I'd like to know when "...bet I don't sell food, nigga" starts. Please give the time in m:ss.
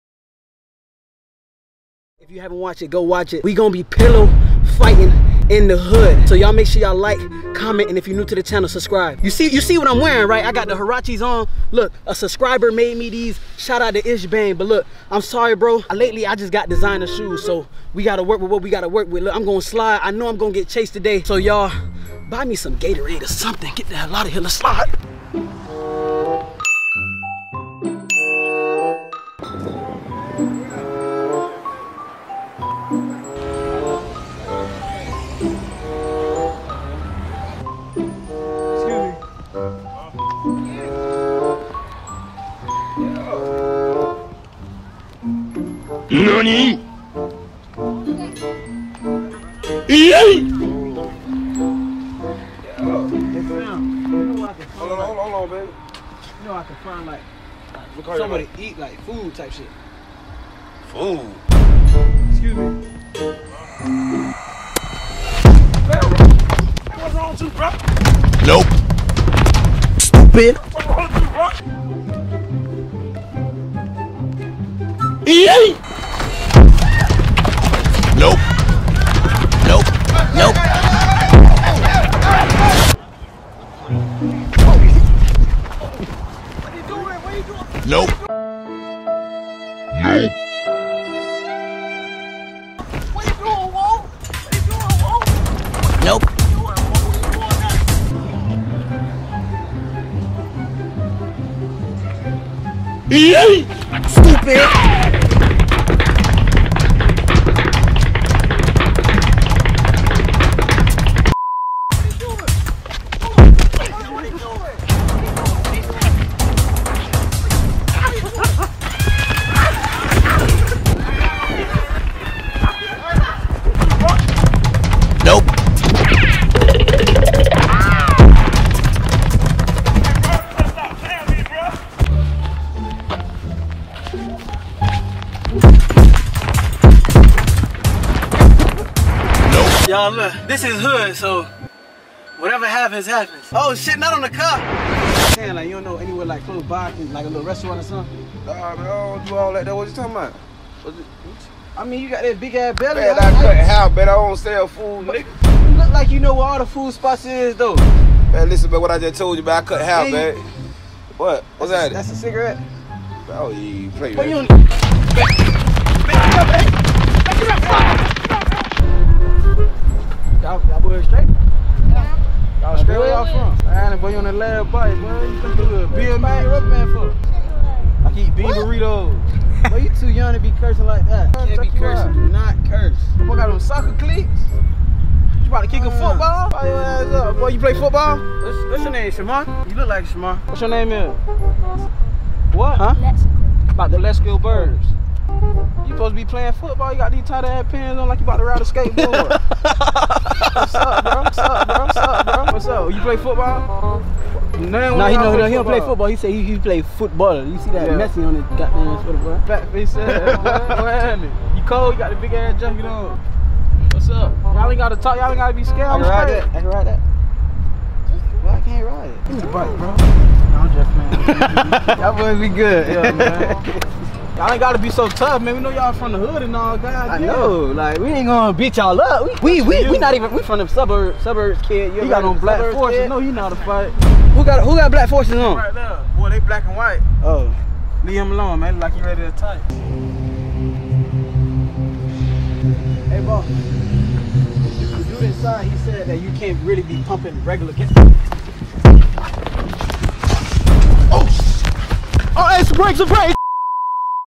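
2:33.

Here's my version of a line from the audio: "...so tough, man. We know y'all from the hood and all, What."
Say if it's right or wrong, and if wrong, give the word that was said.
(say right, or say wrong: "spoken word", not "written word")
wrong: "God", not "What".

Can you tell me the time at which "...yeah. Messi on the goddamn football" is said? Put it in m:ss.
3:27.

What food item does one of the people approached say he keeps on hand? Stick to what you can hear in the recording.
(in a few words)
bean burritos.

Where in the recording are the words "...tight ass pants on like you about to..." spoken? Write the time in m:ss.
3:17.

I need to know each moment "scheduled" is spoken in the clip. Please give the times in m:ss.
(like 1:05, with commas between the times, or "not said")
not said.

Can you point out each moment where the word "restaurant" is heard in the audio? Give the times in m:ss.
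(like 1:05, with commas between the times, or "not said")
2:27.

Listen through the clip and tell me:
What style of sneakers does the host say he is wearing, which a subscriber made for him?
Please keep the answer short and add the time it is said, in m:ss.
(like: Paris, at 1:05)
Huaraches, at 0:10.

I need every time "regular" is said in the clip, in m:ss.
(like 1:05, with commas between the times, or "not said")
4:07.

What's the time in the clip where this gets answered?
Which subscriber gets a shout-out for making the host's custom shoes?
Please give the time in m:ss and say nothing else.
0:14.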